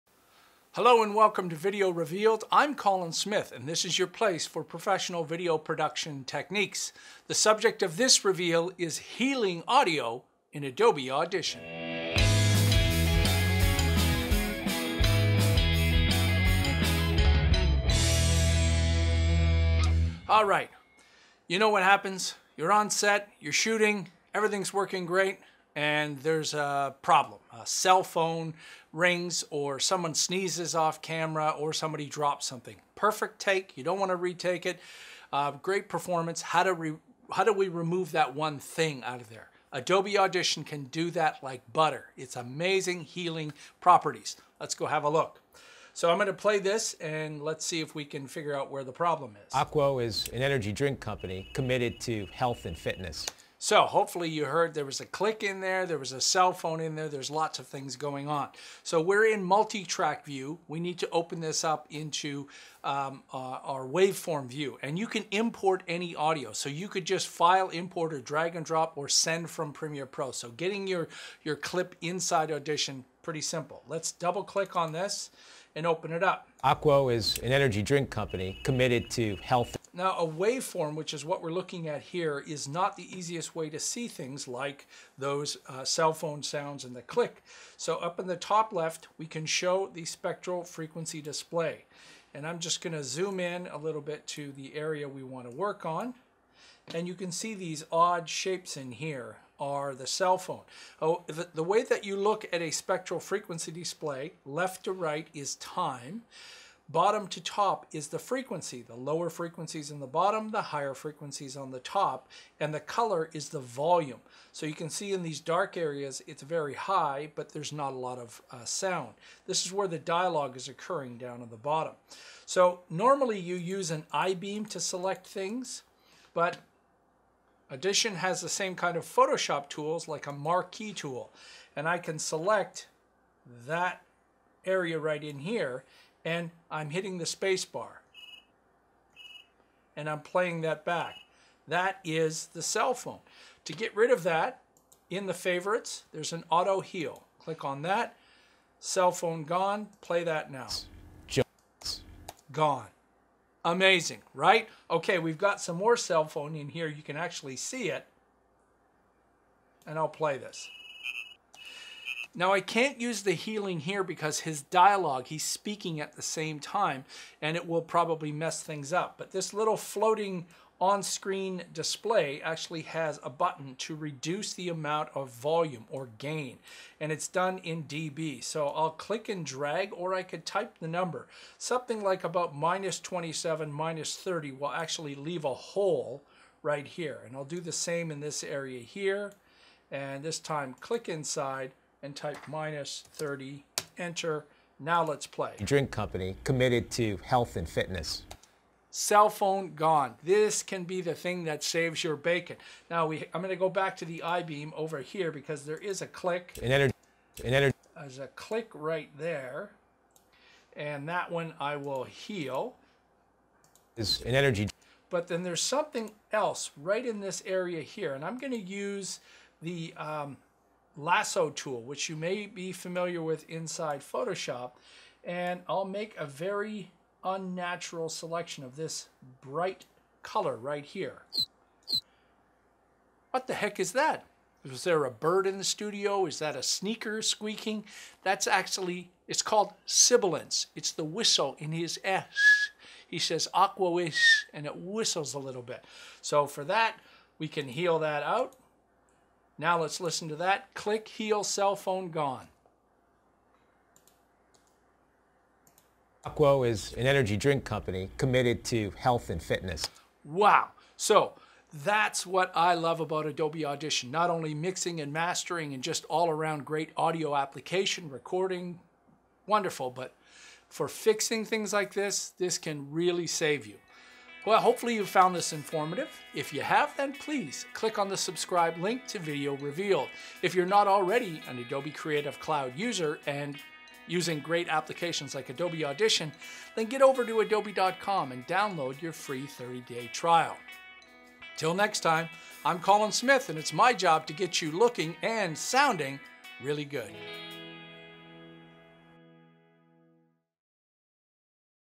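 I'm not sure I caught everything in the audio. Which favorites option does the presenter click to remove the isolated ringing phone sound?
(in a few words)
auto heal.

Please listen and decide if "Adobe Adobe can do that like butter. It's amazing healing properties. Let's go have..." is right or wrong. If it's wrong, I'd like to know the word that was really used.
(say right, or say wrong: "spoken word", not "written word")
wrong: "Audition", not "Adobe".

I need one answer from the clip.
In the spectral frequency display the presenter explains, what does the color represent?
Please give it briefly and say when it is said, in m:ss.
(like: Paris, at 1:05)
the volume, at 1:53.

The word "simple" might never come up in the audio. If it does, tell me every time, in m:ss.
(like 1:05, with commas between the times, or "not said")
1:13.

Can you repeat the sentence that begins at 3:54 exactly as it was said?
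Was there a bird in the studio?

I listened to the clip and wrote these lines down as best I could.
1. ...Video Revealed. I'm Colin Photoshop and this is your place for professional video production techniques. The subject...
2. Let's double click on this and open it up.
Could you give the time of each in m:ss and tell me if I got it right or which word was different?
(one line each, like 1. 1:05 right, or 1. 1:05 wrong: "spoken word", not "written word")
1. 0:01 wrong: "Smith", not "Photoshop"
2. 1:13 right.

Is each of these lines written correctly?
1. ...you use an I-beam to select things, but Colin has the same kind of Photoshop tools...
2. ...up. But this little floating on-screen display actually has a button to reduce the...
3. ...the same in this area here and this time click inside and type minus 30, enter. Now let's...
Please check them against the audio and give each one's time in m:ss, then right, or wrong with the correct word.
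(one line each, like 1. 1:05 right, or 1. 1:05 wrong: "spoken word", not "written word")
1. 2:03 wrong: "Audition", not "Colin"
2. 2:48 right
3. 3:07 right.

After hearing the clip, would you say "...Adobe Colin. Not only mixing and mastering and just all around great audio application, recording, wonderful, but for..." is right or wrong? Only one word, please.
wrong.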